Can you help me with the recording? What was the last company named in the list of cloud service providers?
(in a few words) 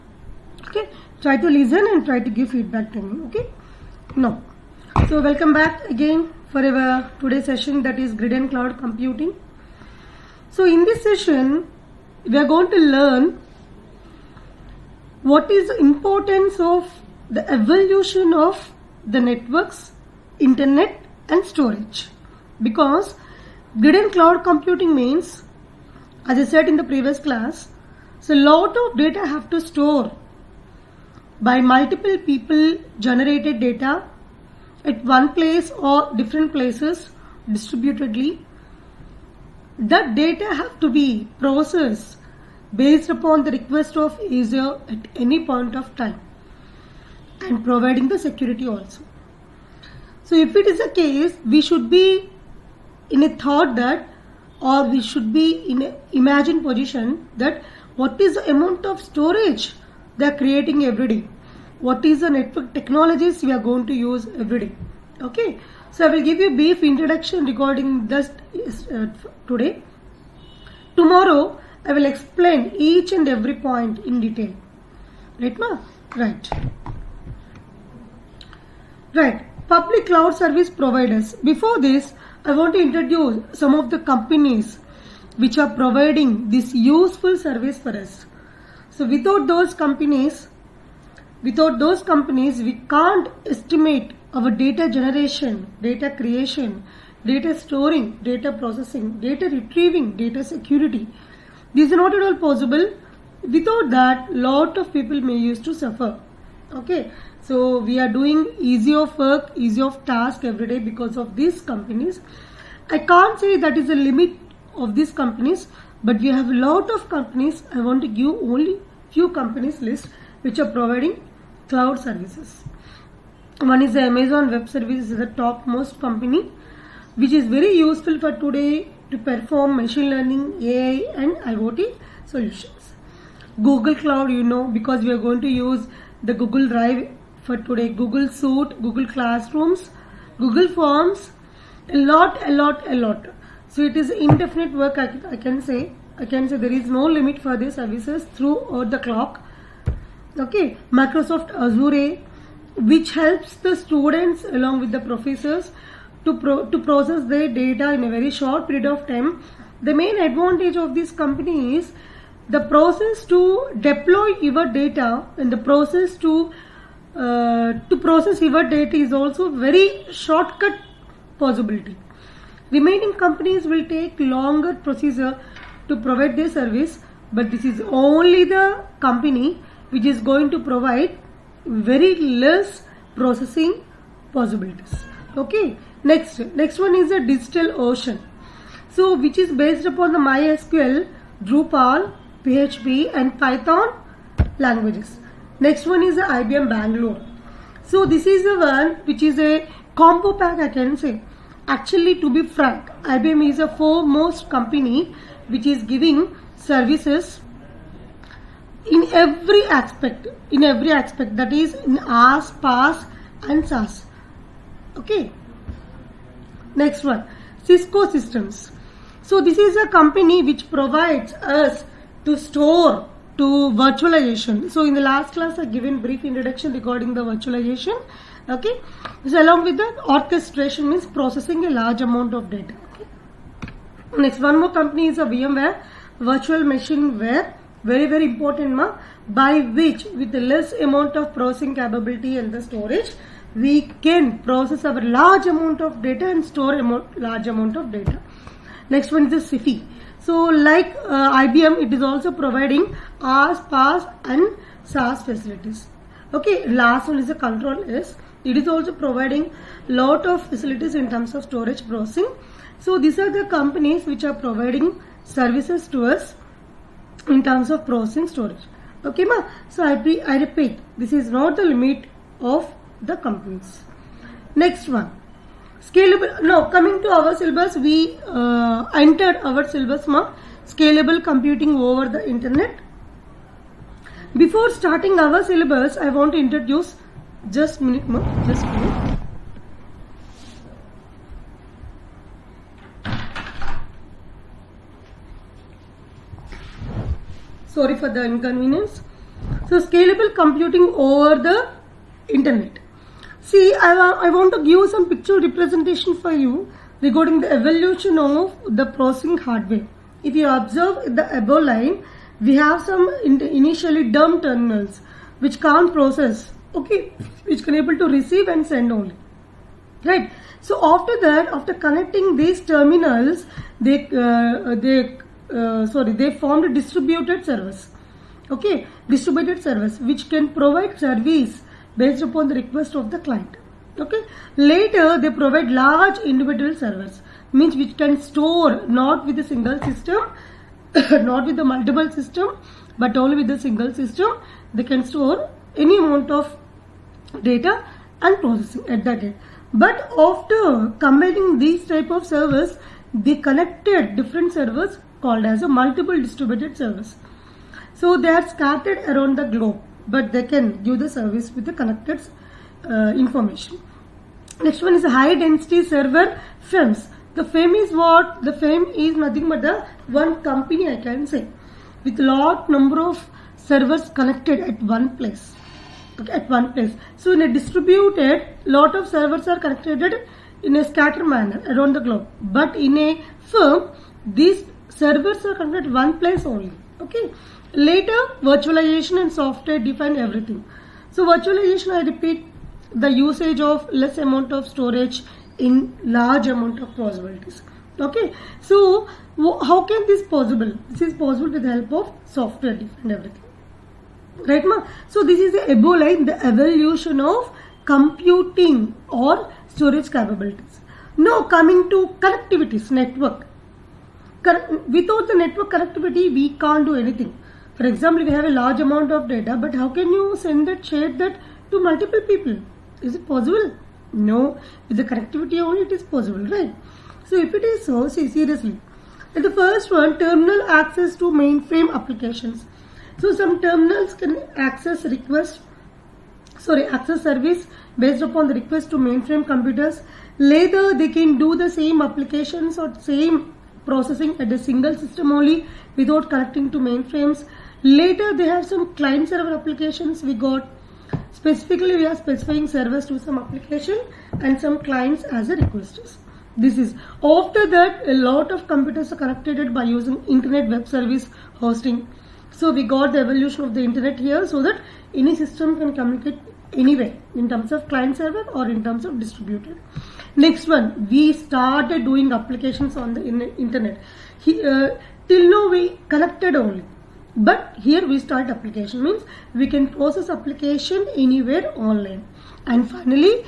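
Control S.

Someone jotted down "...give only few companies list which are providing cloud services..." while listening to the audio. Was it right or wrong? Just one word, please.
right.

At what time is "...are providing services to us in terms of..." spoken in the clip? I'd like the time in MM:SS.
04:24.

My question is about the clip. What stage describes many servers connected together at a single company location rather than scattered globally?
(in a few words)
High density server farms.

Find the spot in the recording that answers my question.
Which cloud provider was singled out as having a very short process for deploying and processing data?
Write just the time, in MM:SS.
02:30.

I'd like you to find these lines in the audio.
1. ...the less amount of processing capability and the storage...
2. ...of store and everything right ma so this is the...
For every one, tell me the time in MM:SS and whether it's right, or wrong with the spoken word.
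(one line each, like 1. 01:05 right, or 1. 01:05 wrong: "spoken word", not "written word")
1. 04:00 right
2. 06:42 wrong: "software", not "store".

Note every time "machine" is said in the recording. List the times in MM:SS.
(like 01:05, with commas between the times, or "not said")
02:09, 03:56.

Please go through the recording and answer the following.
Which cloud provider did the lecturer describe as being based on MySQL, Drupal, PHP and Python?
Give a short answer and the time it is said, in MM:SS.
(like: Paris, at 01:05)
Digital Ocean, at 03:07.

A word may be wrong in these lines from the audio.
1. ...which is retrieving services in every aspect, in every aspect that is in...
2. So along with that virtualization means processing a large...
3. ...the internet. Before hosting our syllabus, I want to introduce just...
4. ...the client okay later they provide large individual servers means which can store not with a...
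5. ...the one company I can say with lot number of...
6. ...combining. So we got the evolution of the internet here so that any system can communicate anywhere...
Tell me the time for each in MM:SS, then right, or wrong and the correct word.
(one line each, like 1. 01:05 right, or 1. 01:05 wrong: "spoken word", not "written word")
1. 03:25 wrong: "giving", not "retrieving"
2. 03:49 wrong: "orchestration", not "virtualization"
3. 04:42 wrong: "starting", not "hosting"
4. 05:33 right
5. 06:09 right
6. 07:41 wrong: "hosting", not "combining".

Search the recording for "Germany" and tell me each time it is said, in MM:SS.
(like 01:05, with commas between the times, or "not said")
not said.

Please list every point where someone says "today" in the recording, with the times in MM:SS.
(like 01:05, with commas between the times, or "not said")
00:07, 01:09, 02:08, 02:17.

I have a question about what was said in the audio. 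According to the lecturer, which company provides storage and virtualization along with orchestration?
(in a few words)
Cisco Systems.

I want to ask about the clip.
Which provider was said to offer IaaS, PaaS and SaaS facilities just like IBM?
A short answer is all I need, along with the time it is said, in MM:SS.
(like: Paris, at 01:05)
Sify, at 04:09.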